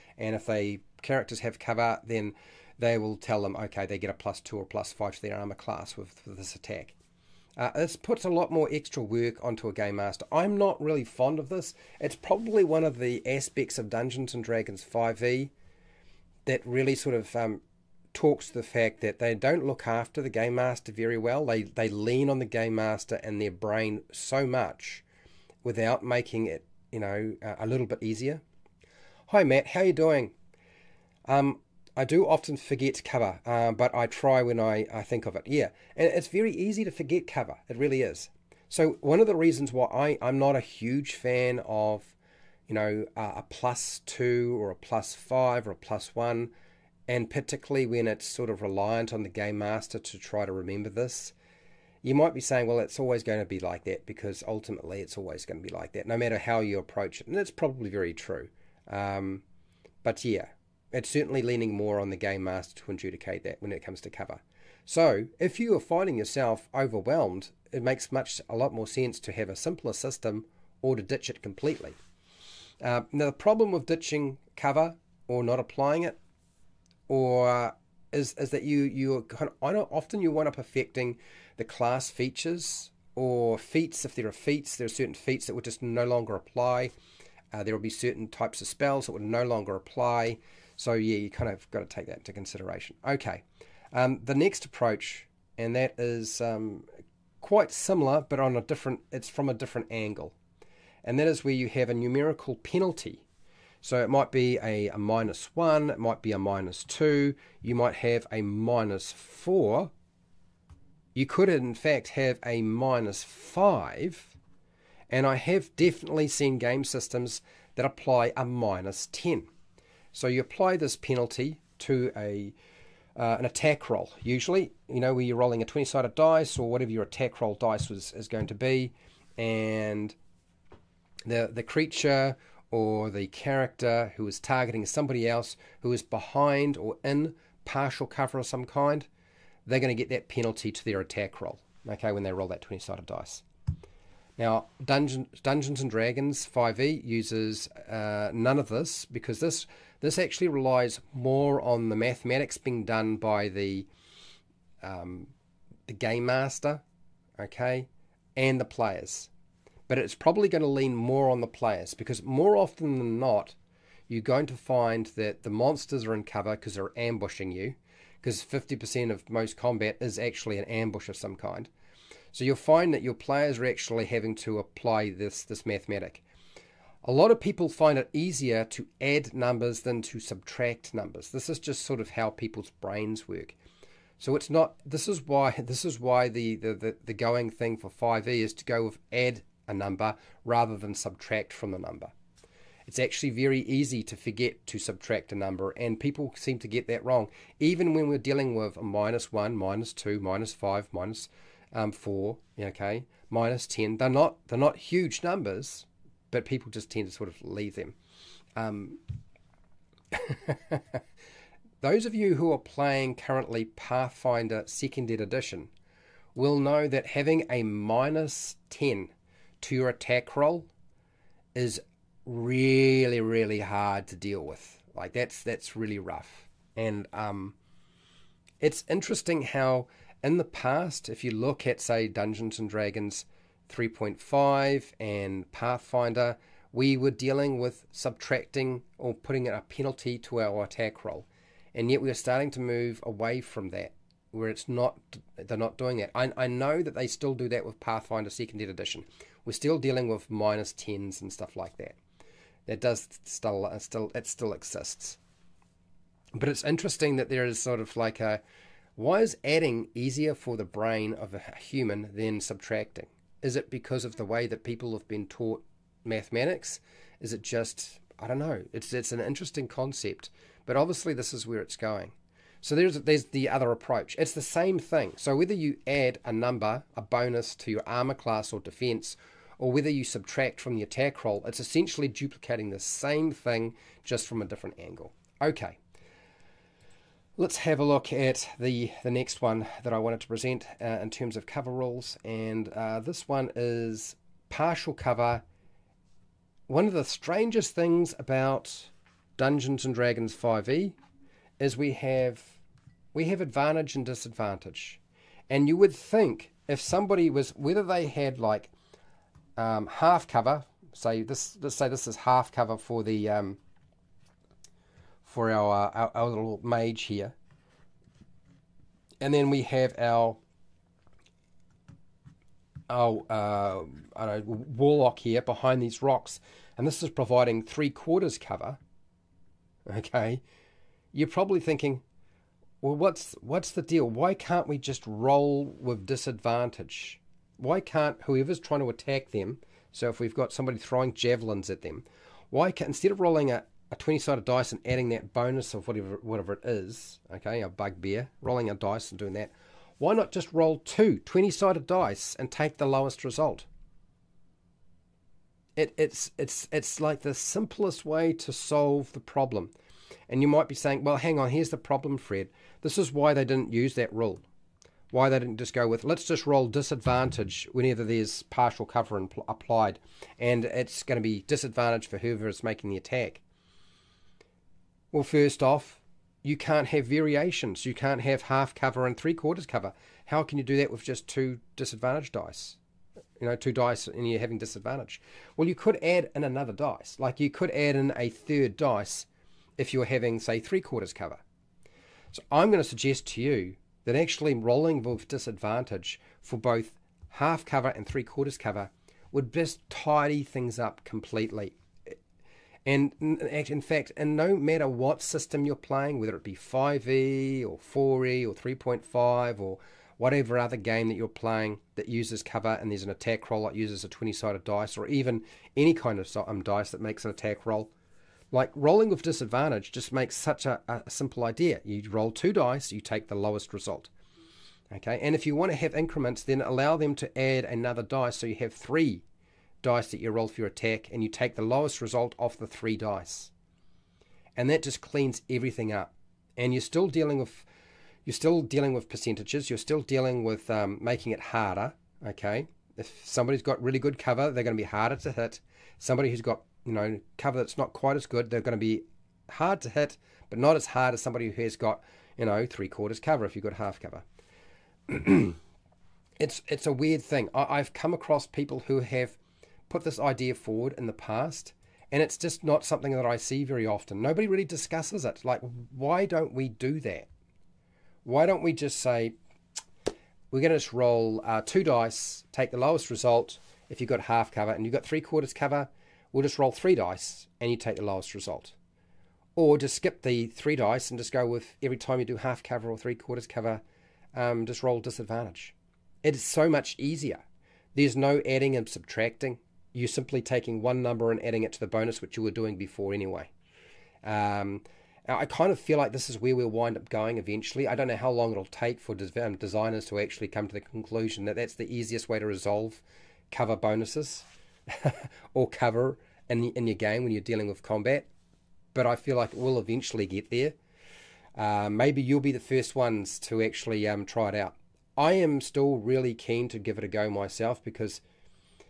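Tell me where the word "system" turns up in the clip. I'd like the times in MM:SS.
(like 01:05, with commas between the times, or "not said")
01:09, 01:56, 06:45.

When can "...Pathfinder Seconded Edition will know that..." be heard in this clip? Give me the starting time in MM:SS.
03:33.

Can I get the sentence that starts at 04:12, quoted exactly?
That does still, uh, still, it still exists.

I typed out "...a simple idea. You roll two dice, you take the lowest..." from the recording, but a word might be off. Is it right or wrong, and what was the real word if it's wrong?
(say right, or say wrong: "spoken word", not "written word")
right.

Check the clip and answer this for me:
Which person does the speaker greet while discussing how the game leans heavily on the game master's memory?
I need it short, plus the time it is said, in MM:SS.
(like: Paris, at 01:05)
Matt, at 00:29.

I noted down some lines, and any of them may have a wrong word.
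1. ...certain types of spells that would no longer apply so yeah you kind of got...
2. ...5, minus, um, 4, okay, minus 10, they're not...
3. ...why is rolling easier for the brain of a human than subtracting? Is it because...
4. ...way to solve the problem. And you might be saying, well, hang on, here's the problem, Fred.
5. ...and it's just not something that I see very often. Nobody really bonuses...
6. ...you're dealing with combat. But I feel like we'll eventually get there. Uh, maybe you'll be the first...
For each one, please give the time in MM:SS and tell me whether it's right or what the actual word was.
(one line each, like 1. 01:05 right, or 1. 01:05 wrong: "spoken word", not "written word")
1. 01:27 right
2. 03:20 right
3. 04:18 wrong: "adding", not "rolling"
4. 05:58 right
5. 07:42 wrong: "discusses", not "bonuses"
6. 08:27 right.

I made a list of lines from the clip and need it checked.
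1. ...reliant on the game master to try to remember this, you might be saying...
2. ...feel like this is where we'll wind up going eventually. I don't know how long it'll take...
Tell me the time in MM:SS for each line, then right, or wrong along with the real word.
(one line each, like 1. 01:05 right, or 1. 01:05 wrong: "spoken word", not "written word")
1. 00:48 right
2. 08:15 right.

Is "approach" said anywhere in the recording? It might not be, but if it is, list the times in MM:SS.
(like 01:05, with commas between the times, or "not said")
00:56, 01:34, 04:33.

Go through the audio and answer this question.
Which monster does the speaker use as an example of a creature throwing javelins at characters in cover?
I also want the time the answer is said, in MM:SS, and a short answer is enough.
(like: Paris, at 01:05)
bugbear, at 05:47.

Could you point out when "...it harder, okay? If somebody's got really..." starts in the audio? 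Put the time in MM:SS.
07:21.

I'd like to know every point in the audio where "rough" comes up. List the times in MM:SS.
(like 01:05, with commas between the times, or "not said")
03:45.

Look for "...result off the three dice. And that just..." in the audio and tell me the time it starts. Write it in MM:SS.
07:11.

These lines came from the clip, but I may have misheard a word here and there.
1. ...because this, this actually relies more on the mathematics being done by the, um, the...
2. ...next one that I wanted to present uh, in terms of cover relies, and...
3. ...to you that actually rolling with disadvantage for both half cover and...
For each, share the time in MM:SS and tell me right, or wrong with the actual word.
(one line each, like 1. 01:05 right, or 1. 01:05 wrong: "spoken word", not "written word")
1. 02:29 right
2. 04:49 wrong: "rules", not "relies"
3. 06:33 right.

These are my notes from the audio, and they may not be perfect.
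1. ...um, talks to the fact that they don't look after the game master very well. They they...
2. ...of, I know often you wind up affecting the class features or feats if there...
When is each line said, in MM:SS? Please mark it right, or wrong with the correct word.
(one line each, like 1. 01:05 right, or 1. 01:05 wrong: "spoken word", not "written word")
1. 00:17 right
2. 01:19 right.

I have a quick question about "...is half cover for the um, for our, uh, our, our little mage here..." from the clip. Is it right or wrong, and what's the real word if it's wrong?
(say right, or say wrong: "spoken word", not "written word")
right.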